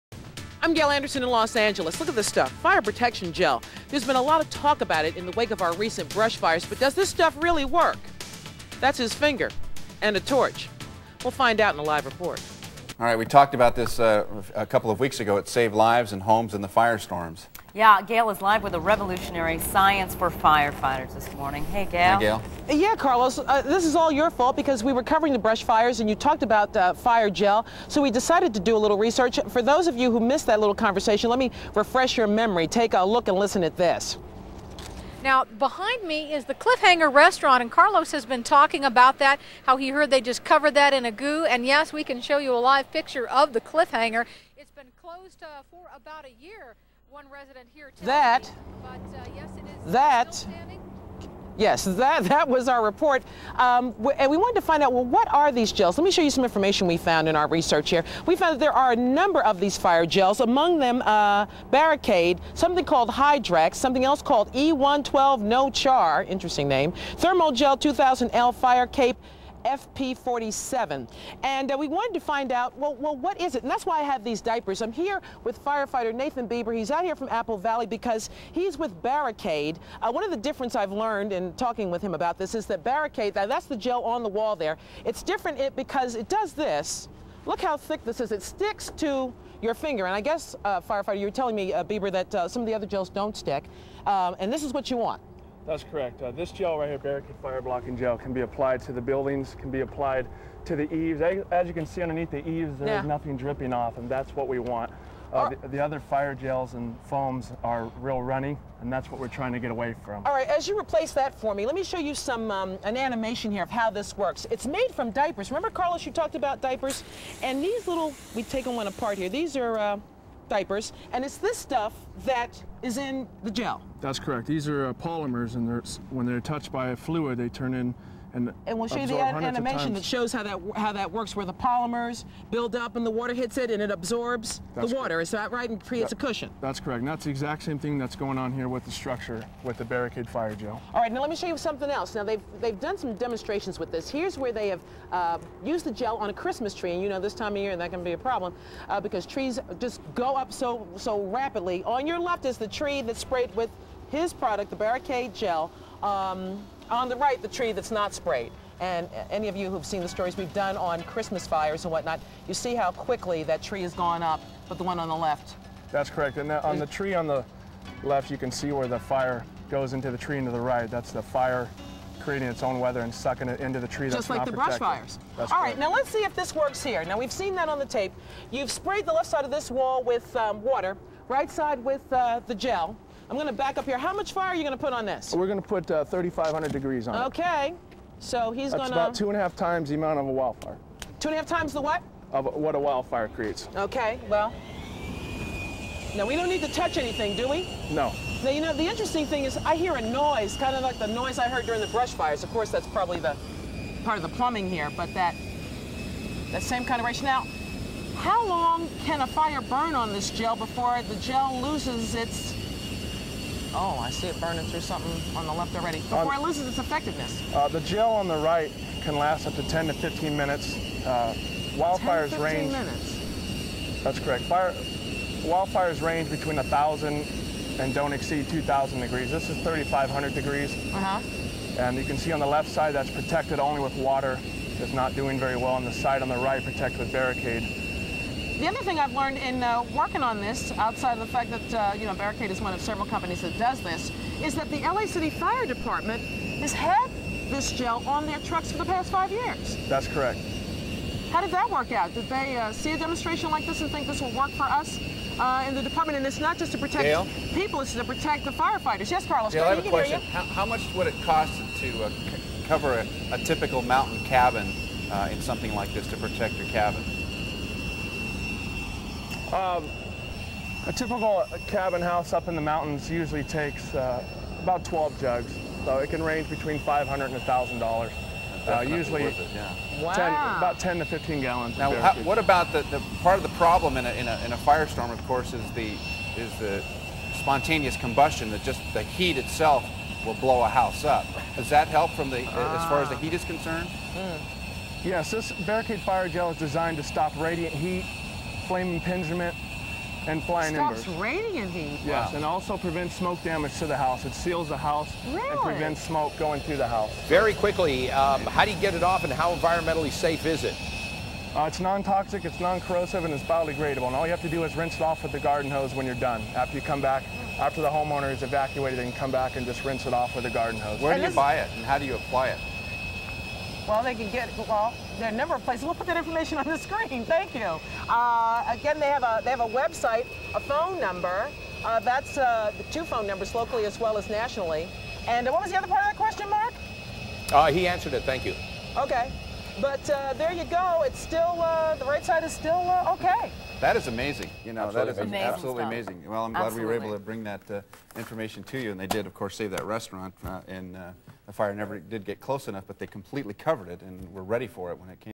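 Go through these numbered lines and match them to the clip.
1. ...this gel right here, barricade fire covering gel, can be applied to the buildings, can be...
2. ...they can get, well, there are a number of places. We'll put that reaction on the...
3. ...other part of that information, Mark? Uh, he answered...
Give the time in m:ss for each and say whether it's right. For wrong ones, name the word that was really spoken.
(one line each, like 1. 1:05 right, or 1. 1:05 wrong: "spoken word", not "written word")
1. 1:36 wrong: "blocking", not "covering"
2. 5:24 wrong: "information", not "reaction"
3. 5:35 wrong: "question", not "information".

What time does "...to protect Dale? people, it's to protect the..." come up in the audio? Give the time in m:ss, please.
4:16.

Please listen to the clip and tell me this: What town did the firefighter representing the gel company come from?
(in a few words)
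Apple Valley.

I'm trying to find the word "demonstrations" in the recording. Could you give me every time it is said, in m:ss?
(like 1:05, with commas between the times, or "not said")
2:23, 4:12.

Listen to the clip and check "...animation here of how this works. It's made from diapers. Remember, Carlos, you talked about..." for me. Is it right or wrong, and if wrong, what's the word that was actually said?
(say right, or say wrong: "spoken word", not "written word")
right.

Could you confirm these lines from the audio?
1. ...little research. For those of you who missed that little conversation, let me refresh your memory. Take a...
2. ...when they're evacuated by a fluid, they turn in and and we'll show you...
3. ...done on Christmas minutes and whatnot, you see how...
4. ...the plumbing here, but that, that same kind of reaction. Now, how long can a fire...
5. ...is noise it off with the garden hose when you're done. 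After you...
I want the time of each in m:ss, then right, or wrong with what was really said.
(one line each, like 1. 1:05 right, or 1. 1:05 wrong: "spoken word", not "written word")
1. 0:28 right
2. 2:06 wrong: "touched", not "evacuated"
3. 2:40 wrong: "fires", not "minutes"
4. 3:24 right
5. 5:14 wrong: "rinse", not "noise".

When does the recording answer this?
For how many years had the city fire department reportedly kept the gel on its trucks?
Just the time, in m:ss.
4:09.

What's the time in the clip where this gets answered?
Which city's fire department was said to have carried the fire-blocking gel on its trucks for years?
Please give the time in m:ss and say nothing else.
4:04.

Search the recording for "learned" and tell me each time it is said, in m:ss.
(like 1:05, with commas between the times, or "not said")
1:20, 3:59.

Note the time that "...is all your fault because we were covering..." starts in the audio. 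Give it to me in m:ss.
0:23.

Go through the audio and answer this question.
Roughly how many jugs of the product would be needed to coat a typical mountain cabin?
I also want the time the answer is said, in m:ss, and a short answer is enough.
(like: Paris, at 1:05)
12, at 4:34.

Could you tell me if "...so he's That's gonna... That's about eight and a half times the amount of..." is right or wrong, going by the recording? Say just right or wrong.
wrong.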